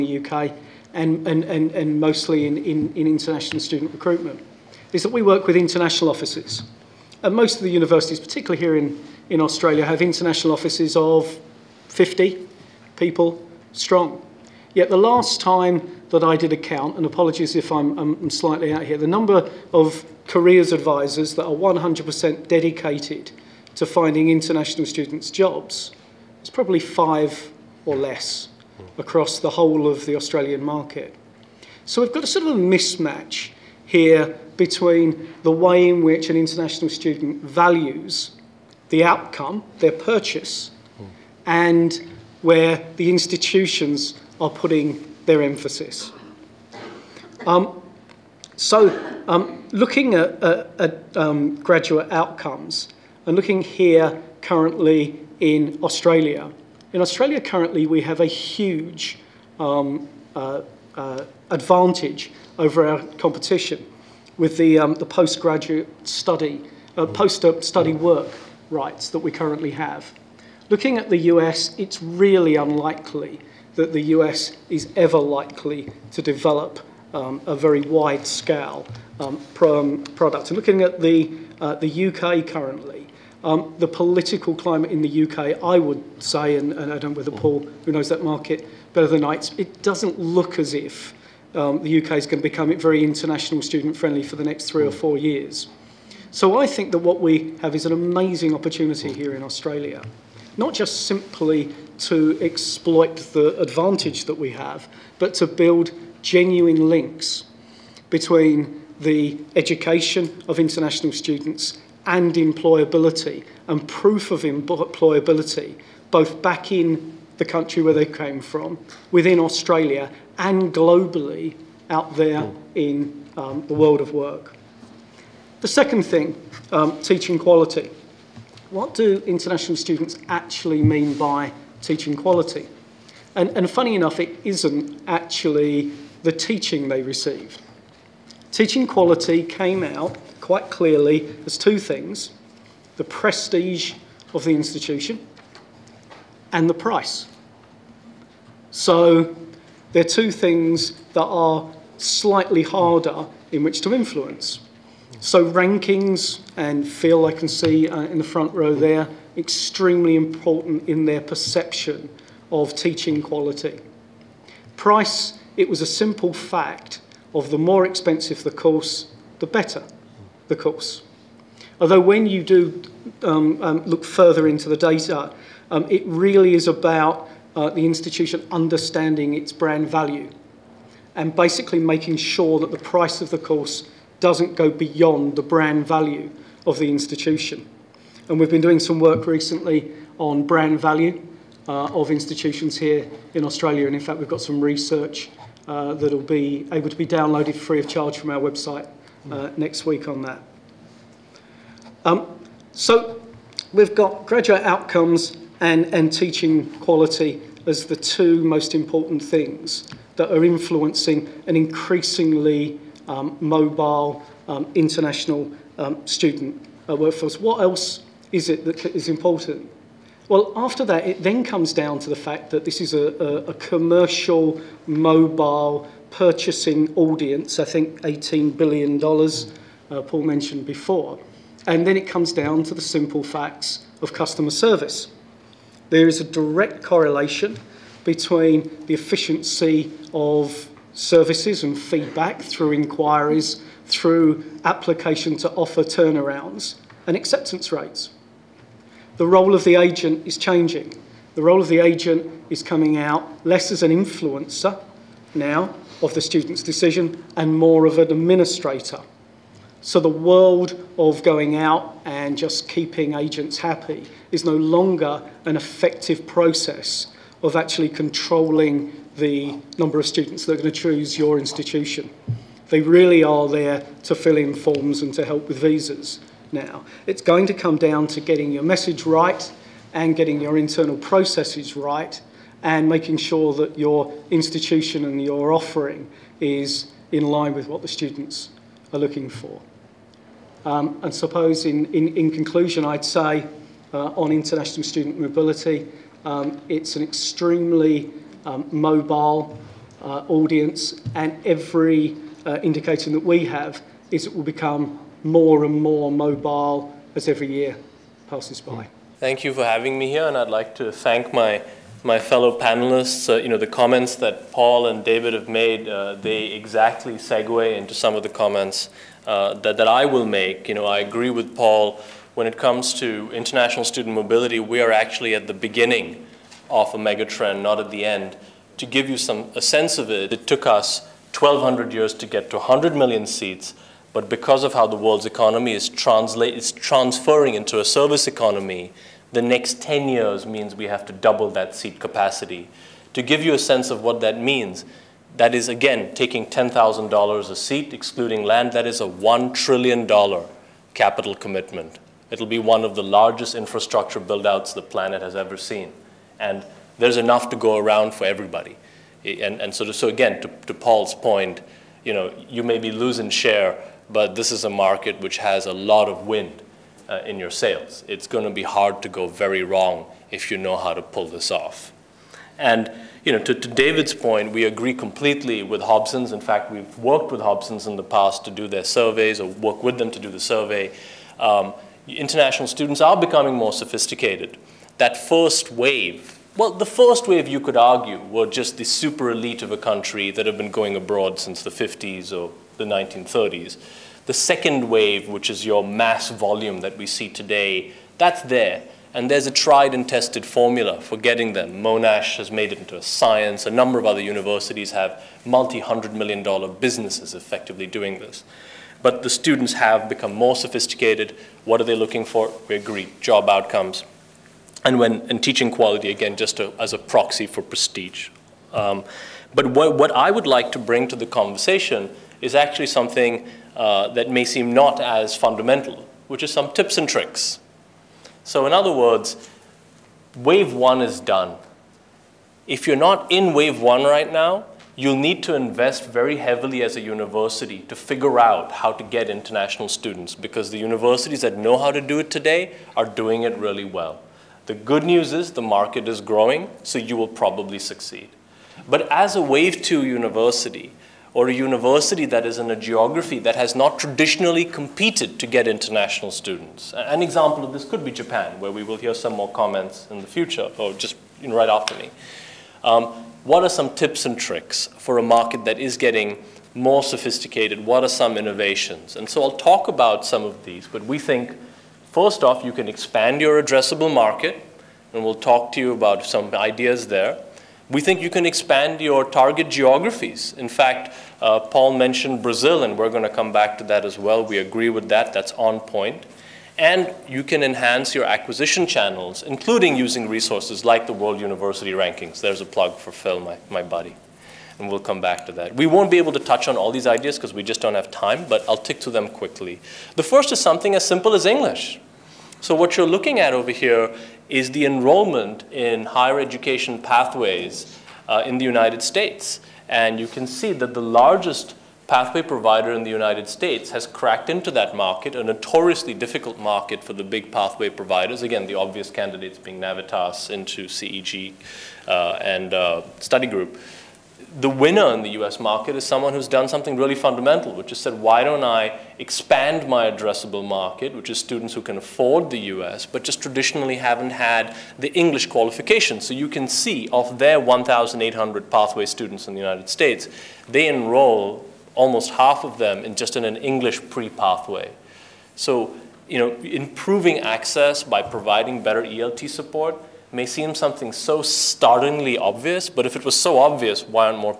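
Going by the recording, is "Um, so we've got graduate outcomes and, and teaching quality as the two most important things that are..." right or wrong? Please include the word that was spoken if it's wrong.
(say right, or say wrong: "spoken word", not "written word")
right.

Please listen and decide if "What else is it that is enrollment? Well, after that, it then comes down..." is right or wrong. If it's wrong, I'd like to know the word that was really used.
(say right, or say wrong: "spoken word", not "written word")
wrong: "important", not "enrollment".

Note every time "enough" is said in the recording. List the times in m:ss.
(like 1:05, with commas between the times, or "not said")
2:13, 5:57.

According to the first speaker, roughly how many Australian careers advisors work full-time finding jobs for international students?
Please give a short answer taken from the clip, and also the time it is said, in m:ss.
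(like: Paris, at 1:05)
5 or less, at 0:26.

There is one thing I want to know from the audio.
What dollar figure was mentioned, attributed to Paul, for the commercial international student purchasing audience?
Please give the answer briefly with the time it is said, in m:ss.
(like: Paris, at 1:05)
$18 billion, at 3:48.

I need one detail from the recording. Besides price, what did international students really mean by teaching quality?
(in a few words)
prestige of the institution.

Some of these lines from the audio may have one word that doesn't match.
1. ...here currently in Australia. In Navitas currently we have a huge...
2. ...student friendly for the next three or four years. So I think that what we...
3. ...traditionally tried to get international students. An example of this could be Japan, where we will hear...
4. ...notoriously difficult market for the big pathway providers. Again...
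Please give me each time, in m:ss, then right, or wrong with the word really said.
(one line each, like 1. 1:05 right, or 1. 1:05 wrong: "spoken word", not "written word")
1. 0:53 wrong: "Australia", not "Navitas"
2. 1:33 right
3. 7:33 wrong: "competed", not "tried"
4. 8:35 right.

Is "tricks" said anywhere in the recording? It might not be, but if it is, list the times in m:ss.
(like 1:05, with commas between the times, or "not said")
7:07, 7:44.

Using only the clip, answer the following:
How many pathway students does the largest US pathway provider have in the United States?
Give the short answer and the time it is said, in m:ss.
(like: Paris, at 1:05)
1,800, at 8:57.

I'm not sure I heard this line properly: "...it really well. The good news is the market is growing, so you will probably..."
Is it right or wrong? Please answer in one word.
right.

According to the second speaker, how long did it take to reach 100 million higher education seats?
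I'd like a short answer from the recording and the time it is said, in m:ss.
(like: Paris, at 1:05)
1,200 years, at 5:31.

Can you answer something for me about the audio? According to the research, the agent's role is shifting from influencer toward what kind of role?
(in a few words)
administrator.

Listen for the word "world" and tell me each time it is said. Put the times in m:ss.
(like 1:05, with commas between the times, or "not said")
2:03, 4:20, 5:34, 8:11.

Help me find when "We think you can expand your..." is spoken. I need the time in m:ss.
7:57.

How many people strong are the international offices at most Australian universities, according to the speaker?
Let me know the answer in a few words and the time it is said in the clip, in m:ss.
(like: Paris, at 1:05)
50, at 0:11.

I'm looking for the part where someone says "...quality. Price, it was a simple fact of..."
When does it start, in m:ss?
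2:43.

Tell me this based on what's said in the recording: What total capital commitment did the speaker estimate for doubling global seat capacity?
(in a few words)
$1 trillion.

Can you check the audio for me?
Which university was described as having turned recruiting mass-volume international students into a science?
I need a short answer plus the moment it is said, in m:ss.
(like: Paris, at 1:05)
Monash, at 6:41.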